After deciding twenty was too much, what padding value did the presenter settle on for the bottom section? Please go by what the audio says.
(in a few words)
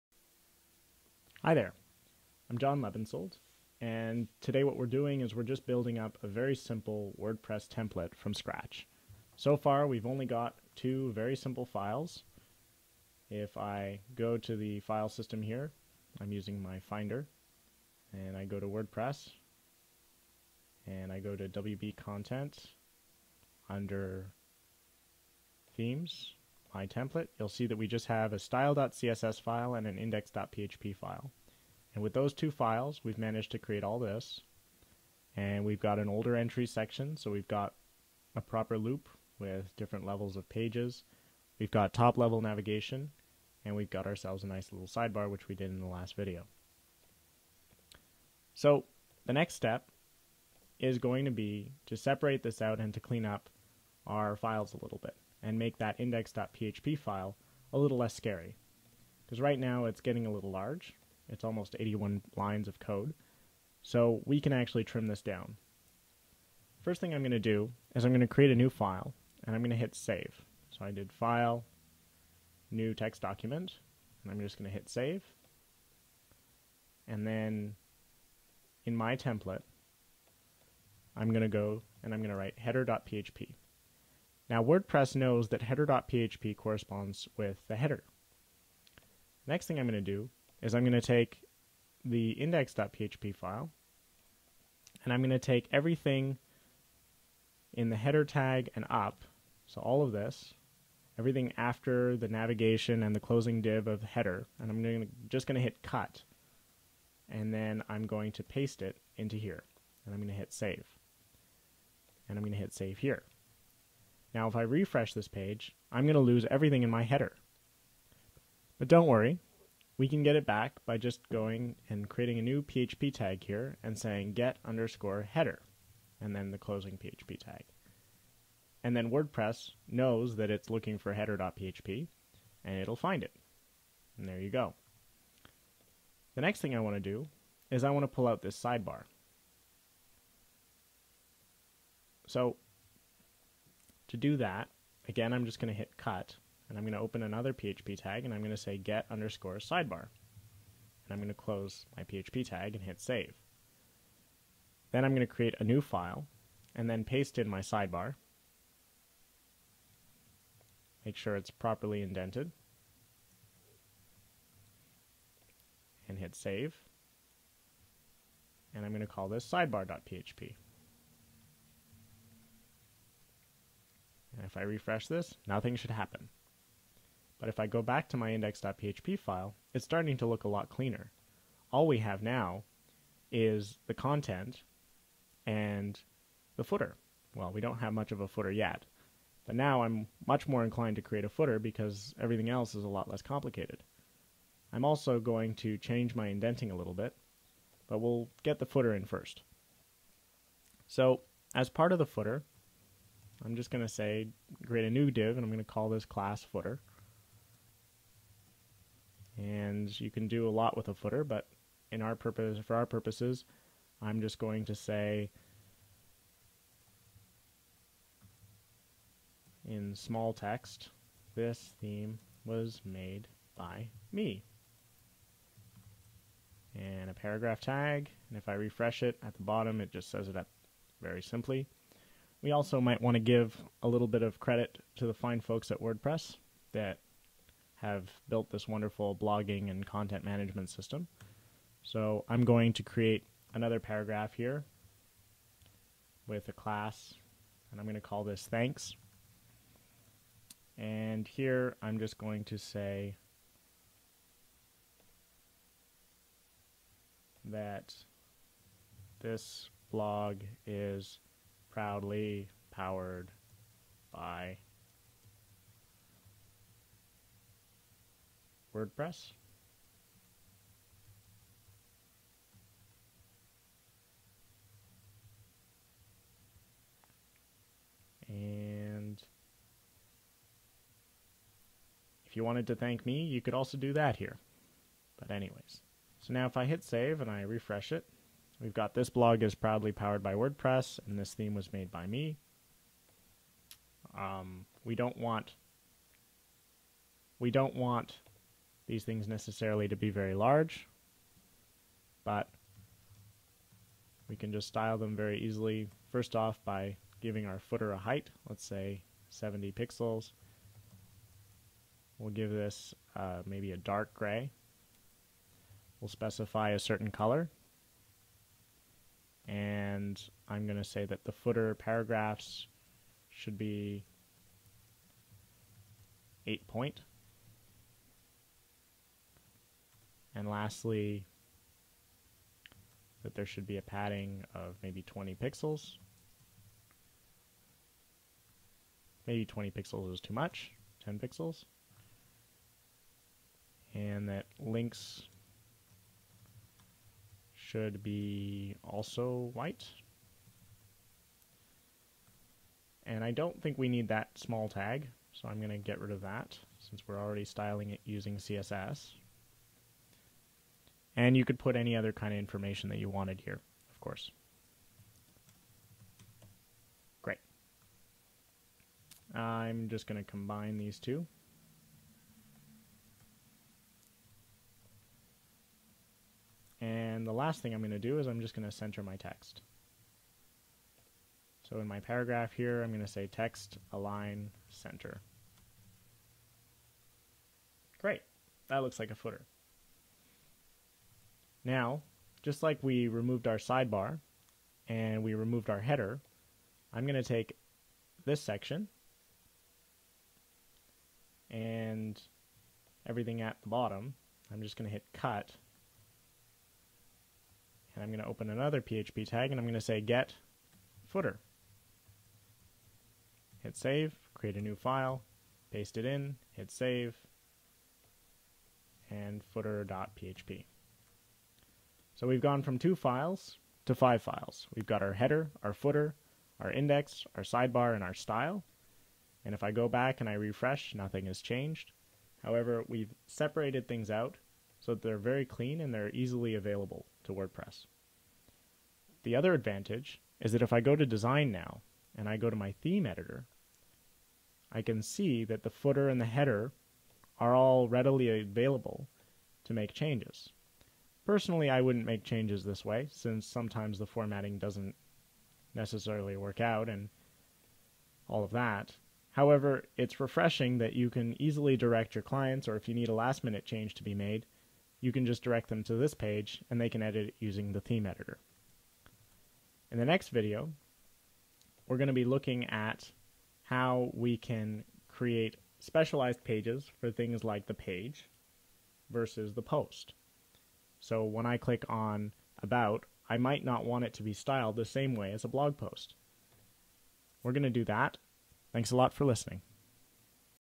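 10 pixels.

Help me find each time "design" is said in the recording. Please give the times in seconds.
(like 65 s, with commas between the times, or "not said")
441 s.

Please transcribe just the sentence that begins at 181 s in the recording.
All we have now is the content and the footer.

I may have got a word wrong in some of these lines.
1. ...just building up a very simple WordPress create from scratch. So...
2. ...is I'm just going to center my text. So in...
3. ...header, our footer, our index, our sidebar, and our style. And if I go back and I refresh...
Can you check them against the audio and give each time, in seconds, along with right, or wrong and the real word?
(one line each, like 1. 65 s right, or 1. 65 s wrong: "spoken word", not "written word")
1. 5 s wrong: "template", not "create"
2. 378 s right
3. 425 s right.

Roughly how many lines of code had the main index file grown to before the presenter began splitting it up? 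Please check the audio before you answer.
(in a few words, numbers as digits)
81.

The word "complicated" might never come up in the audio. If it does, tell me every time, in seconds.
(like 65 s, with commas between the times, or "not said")
193 s.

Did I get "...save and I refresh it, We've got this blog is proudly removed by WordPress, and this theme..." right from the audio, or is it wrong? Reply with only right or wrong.
wrong.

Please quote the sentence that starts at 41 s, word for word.
We've got top level navigation, and we've got ourselves a nice little sidebar, which we did in the last video.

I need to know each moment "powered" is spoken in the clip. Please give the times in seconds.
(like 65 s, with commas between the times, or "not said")
262 s, 289 s.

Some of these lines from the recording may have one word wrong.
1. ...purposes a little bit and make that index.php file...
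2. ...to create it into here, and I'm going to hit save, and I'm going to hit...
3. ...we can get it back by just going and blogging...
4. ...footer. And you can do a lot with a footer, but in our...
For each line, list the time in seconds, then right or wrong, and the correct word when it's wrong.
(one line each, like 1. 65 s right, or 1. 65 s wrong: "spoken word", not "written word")
1. 54 s wrong: "files", not "purposes"
2. 108 s wrong: "paste", not "create"
3. 119 s wrong: "creating", not "blogging"
4. 206 s right.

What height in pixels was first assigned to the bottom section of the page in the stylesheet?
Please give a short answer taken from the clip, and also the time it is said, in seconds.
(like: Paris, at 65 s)
70 pixels, at 309 s.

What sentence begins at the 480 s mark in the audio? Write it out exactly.
So when I click on About, I might not want it to be styled the same way as a blog post.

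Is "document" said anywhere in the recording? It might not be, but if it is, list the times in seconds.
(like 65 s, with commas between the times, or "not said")
73 s.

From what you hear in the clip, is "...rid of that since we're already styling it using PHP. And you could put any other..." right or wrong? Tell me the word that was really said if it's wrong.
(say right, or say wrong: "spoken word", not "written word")
wrong: "CSS", not "PHP".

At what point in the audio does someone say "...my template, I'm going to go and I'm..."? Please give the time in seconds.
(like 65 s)
78 s.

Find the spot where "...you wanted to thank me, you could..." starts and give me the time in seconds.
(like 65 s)
282 s.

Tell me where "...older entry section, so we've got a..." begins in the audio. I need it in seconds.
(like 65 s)
36 s.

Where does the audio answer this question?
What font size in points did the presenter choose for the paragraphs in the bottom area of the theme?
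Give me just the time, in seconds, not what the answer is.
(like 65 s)
326 s.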